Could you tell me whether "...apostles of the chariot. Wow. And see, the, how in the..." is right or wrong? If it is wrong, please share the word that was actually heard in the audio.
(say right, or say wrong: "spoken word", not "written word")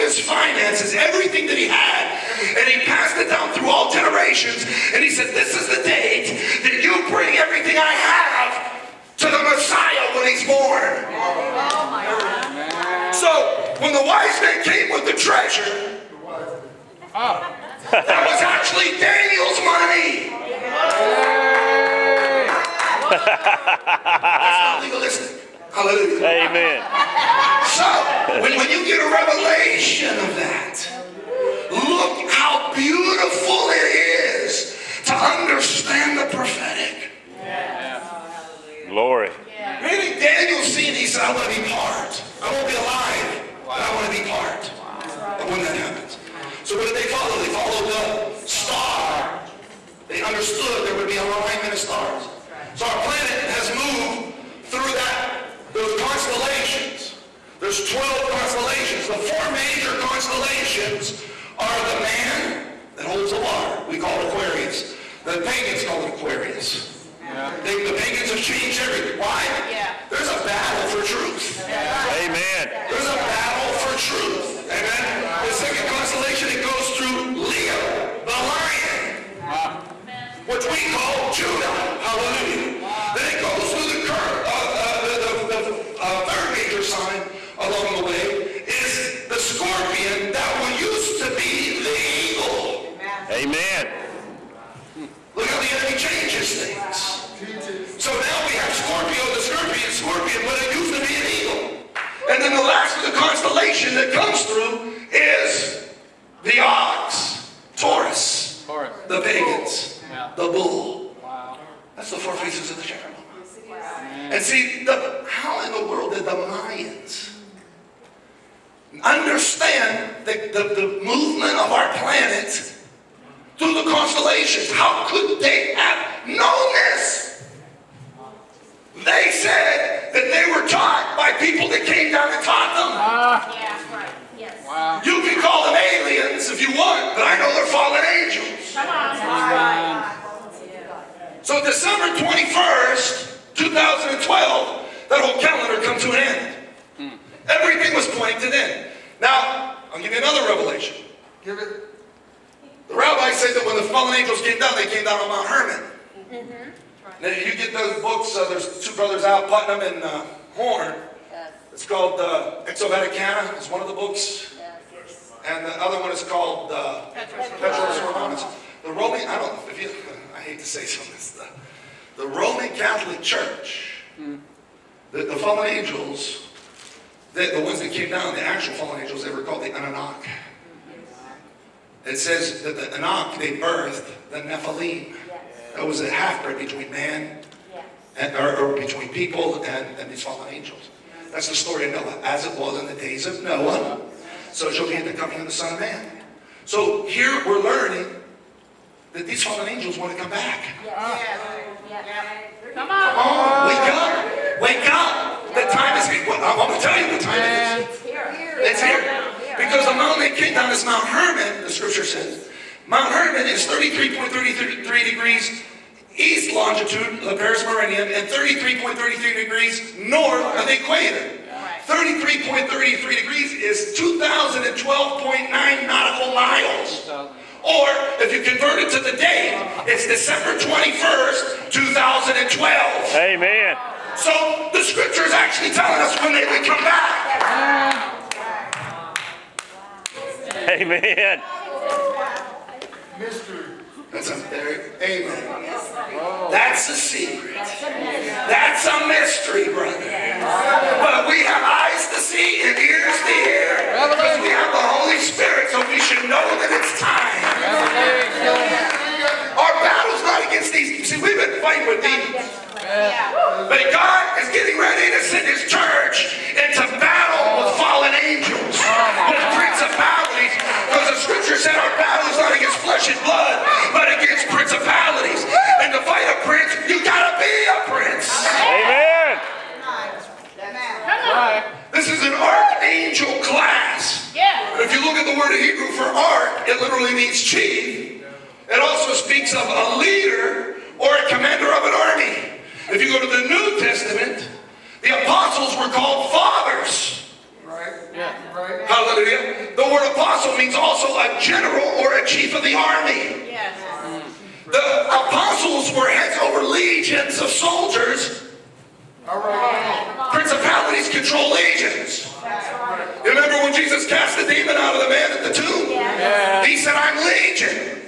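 wrong: "faces", not "apostles".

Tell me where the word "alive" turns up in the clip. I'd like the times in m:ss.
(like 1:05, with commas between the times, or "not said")
0:42.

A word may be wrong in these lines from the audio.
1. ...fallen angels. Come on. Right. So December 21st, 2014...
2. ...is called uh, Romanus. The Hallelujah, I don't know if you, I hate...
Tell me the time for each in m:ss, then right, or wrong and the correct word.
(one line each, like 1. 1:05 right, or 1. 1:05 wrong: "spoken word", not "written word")
1. 2:17 wrong: "2012", not "2014"
2. 2:46 wrong: "Roman", not "Hallelujah".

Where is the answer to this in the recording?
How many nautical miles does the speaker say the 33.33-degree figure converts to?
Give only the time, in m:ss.
3:43.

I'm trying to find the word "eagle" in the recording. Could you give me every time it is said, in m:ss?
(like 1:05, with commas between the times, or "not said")
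1:31, 1:41.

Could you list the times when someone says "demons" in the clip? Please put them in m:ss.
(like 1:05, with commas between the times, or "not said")
4:22, 5:14.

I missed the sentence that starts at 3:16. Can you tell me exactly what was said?
So here we're learning that these fallen angels want to come back.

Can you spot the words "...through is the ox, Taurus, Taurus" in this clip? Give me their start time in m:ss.
1:44.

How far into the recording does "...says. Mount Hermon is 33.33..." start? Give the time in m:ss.
3:32.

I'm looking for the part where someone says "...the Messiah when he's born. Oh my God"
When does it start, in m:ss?
0:09.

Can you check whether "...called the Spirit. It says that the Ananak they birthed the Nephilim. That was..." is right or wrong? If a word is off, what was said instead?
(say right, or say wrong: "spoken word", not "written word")
wrong: "Ananak", not "Spirit".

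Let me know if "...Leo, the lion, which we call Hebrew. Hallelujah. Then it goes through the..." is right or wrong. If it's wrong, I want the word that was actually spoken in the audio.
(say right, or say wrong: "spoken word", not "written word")
wrong: "Judah", not "Hebrew".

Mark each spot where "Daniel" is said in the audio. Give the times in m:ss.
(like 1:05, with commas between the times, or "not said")
0:18, 0:40.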